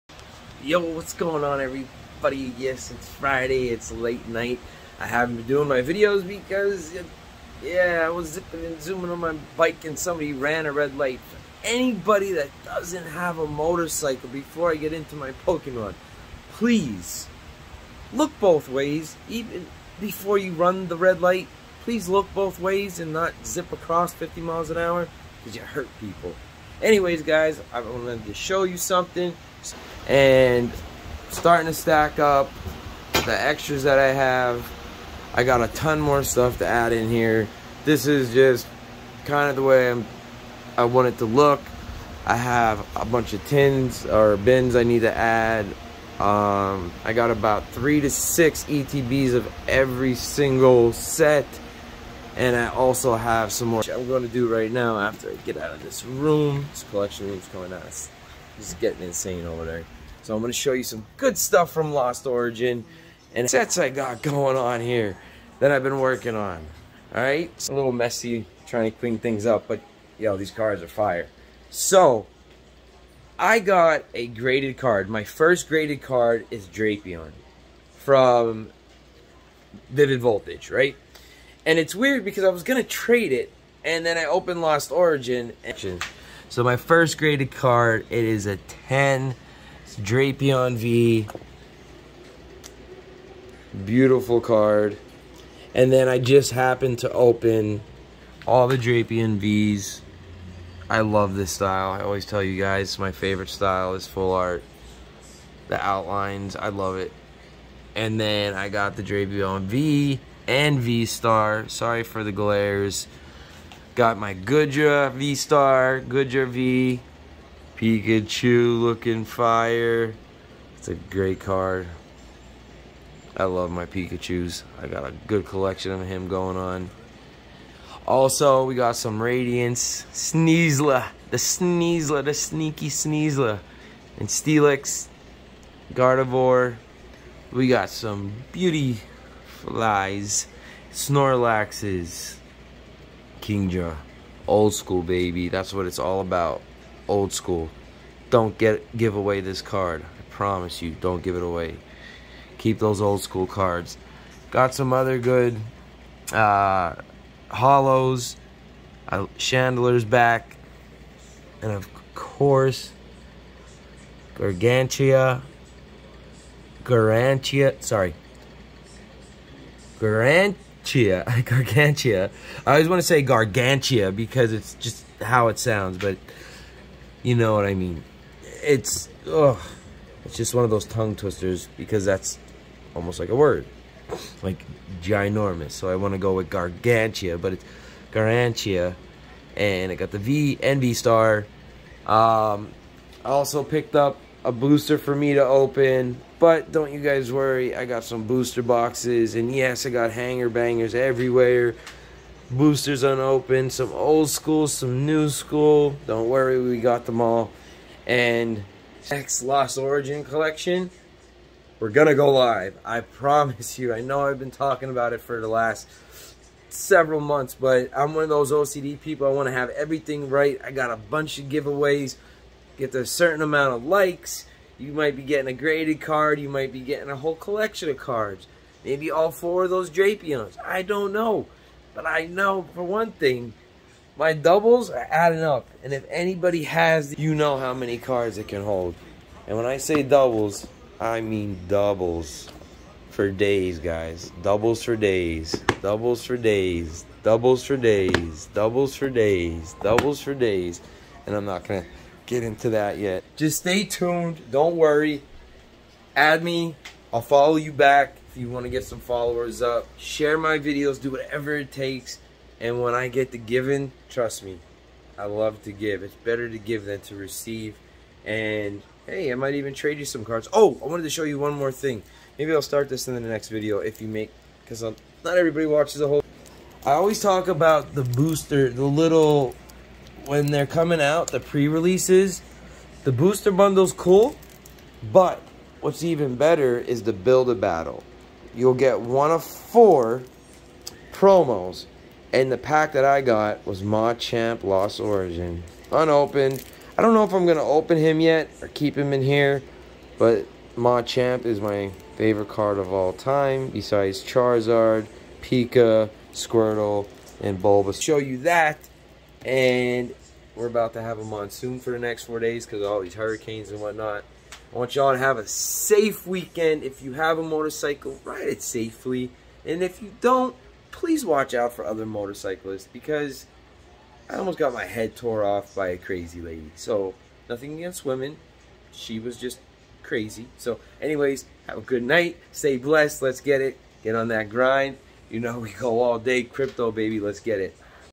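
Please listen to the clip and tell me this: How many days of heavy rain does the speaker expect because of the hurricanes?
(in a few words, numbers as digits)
4.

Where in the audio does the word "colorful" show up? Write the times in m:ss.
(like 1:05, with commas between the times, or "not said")
not said.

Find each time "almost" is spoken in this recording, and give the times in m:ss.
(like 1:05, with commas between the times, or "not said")
3:02, 5:24.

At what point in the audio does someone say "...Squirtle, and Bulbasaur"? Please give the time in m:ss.
5:06.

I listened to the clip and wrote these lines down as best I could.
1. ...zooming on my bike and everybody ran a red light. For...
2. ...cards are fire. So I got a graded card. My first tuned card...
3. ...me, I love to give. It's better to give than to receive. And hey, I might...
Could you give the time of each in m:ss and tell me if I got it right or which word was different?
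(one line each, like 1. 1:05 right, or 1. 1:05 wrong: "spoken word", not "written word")
1. 0:08 wrong: "somebody", not "everybody"
2. 1:10 wrong: "graded", not "tuned"
3. 4:24 right.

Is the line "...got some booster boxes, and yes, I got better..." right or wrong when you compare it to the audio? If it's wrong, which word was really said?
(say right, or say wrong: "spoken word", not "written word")
wrong: "hanger", not "better".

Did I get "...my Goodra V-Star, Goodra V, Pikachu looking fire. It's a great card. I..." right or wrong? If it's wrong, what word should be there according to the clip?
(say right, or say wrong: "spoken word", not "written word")
right.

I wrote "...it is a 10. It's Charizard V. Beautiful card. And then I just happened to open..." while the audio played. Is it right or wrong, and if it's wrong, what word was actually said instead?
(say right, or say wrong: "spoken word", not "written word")
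wrong: "Drapion", not "Charizard".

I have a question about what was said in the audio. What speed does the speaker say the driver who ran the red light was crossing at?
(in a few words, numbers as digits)
50 miles an hour.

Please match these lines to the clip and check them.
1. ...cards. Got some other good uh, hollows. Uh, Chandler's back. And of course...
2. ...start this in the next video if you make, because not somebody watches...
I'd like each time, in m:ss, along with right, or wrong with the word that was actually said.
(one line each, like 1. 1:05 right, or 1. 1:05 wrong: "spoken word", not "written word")
1. 2:33 right
2. 4:32 wrong: "everybody", not "somebody".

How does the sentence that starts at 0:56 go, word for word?
This collection room's coming out it's getting insane over there.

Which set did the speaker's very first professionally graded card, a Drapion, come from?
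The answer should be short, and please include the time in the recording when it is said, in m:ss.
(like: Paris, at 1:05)
Vivid Voltage, at 1:19.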